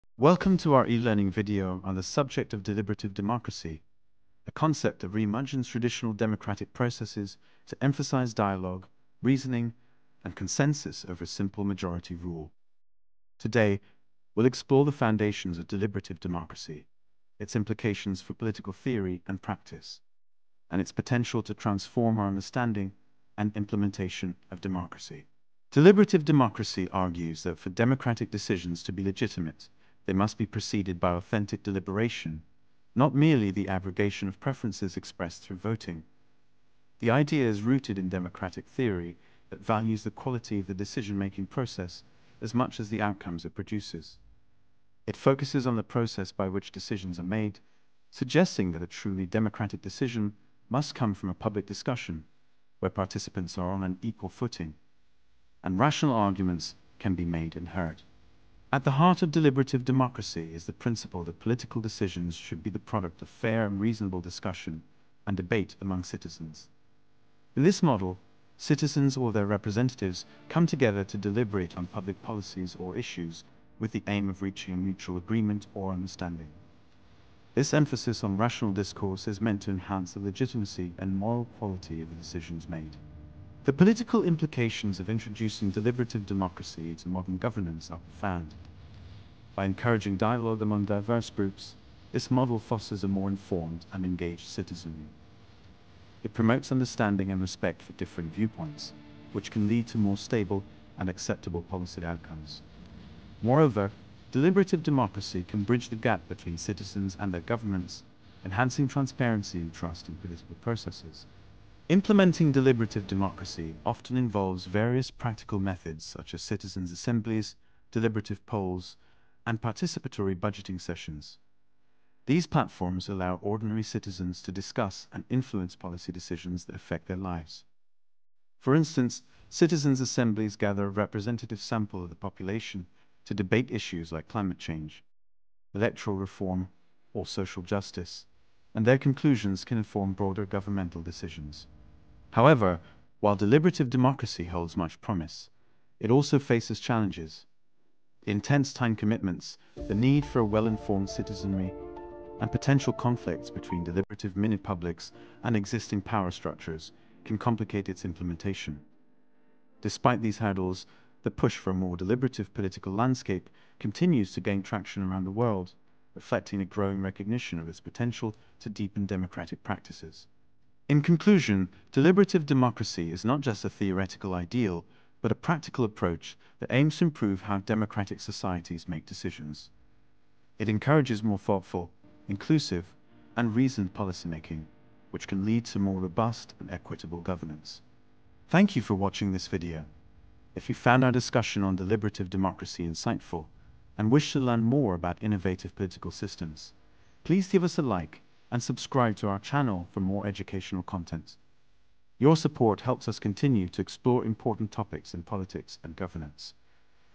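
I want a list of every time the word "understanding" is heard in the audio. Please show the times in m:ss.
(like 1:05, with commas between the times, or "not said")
0:22, 1:15, 1:36.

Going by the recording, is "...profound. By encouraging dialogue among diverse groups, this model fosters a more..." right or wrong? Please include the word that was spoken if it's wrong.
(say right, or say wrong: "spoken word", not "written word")
right.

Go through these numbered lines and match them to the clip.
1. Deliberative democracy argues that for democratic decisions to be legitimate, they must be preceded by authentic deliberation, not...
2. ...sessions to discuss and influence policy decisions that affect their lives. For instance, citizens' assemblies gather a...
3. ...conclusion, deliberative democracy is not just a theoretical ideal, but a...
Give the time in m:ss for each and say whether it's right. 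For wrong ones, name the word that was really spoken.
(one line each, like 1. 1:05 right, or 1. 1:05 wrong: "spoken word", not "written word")
1. 0:25 right
2. 2:03 wrong: "citizens", not "sessions"
3. 2:51 right.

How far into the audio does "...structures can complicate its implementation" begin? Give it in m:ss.
2:36.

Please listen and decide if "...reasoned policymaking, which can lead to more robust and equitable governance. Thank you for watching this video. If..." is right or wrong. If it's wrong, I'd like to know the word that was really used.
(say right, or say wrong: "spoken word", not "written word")
right.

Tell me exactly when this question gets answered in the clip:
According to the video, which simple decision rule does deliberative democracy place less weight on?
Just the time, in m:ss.
0:11.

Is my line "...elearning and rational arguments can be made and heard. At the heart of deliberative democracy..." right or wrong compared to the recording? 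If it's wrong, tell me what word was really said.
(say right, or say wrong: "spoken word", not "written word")
wrong: "footing", not "elearning".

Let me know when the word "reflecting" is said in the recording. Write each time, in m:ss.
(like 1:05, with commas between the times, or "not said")
2:46.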